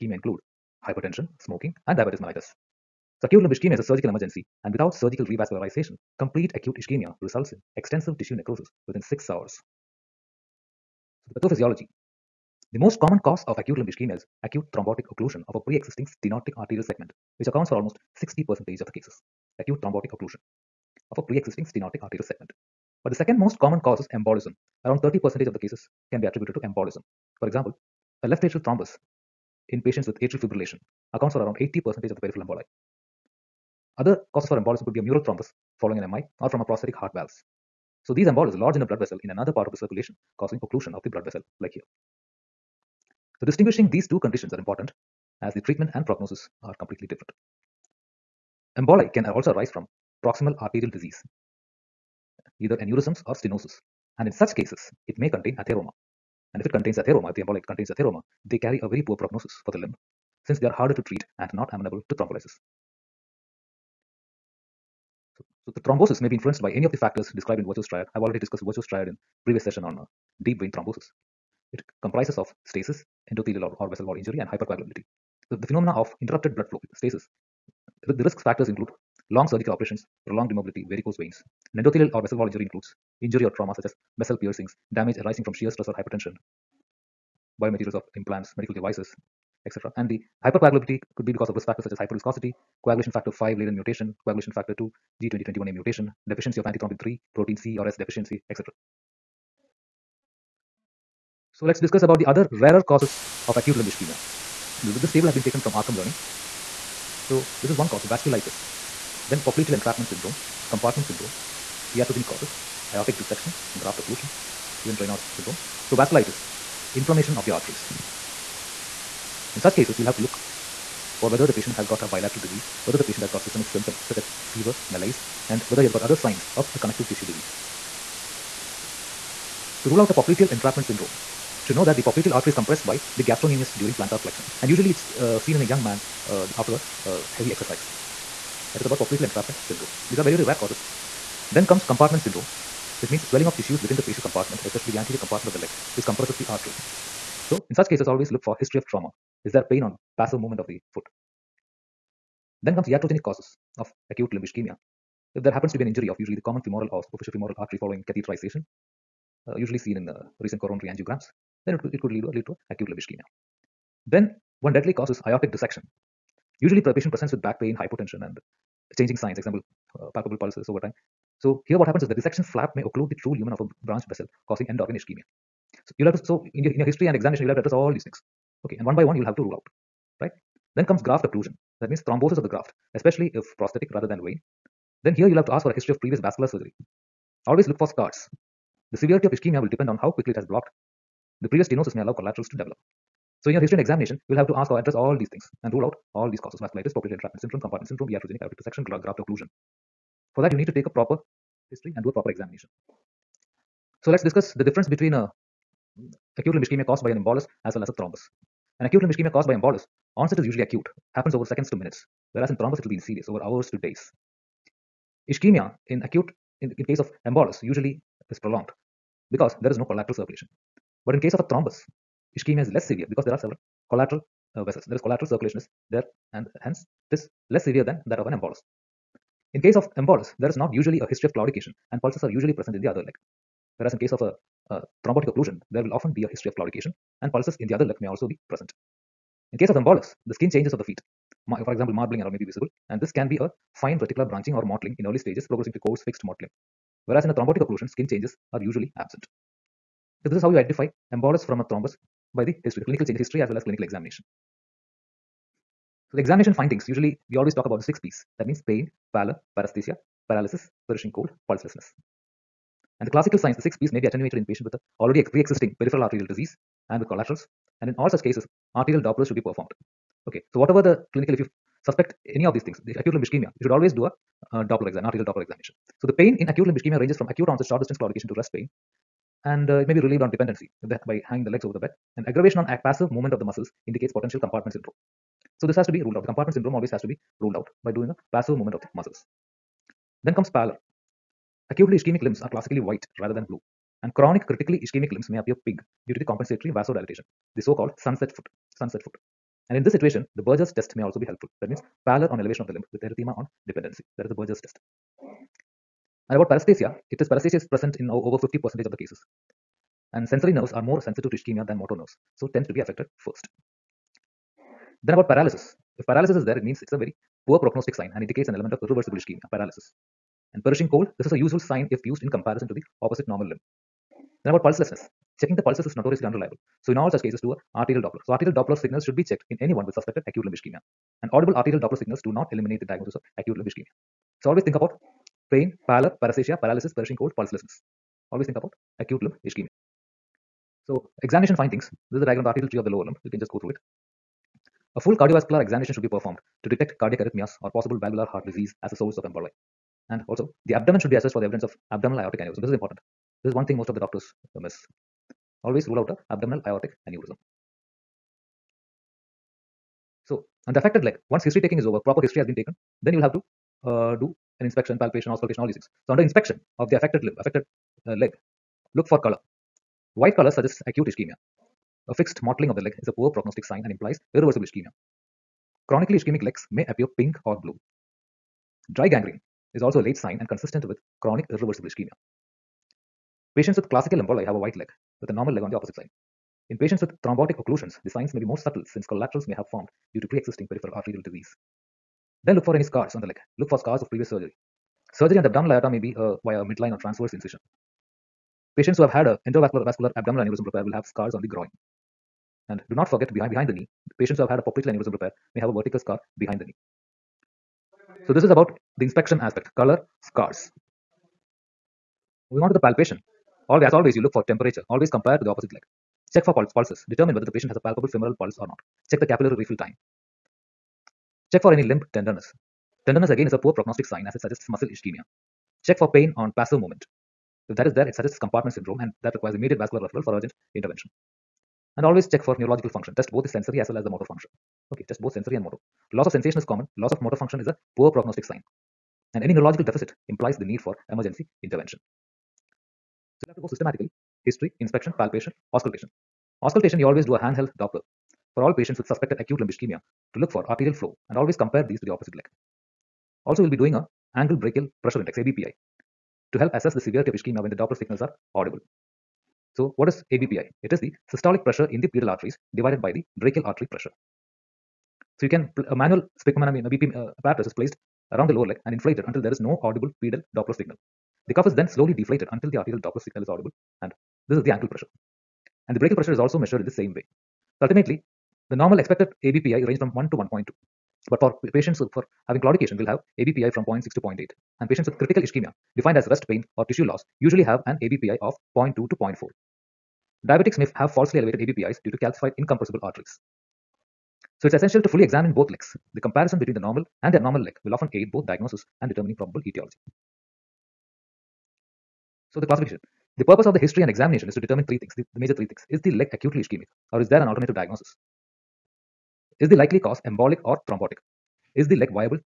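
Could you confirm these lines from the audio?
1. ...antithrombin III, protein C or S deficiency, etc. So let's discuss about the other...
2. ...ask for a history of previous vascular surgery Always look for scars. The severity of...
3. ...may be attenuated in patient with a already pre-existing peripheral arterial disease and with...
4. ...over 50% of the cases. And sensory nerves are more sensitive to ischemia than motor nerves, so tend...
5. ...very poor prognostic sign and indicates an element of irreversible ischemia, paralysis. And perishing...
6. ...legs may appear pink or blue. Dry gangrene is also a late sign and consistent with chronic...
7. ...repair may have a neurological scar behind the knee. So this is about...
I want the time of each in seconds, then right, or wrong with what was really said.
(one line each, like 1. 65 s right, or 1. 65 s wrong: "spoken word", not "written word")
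1. 96 s right
2. 185 s right
3. 263 s right
4. 308 s right
5. 316 s right
6. 376 s right
7. 405 s wrong: "vertical", not "neurological".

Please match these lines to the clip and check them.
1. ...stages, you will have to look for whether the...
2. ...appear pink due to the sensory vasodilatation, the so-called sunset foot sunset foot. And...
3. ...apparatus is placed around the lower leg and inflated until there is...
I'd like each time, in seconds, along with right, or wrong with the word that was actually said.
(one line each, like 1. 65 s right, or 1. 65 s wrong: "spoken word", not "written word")
1. 119 s wrong: "cases", not "stages"
2. 295 s wrong: "compensatory", not "sensory"
3. 467 s right.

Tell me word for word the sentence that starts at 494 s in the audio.
So it's essential to fully examine both legs.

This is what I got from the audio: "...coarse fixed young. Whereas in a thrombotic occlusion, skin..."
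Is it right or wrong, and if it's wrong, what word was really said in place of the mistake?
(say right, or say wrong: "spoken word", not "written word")
wrong: "mottling", not "young".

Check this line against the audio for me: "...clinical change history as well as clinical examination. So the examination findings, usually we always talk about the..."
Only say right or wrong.
right.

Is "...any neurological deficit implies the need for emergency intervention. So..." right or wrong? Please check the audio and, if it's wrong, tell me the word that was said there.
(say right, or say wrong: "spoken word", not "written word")
right.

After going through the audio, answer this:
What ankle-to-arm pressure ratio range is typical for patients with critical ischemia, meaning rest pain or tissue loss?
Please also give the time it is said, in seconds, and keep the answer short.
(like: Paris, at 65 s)
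0.2 to 0.4, at 488 s.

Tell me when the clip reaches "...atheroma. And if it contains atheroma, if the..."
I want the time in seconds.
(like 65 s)
55 s.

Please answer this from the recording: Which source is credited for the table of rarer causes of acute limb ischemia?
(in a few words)
RCEM Learning.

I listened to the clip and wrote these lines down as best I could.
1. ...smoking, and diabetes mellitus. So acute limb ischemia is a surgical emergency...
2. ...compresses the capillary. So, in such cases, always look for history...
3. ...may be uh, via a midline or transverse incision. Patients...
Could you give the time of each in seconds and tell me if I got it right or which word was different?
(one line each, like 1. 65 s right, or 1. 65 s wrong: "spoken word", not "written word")
1. 1 s right
2. 146 s wrong: "artery", not "capillary"
3. 395 s right.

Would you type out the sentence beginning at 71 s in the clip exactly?
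It comprises of stasis, endothelial or, or vessel wall injury and hypercoagulability.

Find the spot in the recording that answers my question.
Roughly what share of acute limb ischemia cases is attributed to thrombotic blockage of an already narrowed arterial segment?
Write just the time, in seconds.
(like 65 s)
17 s.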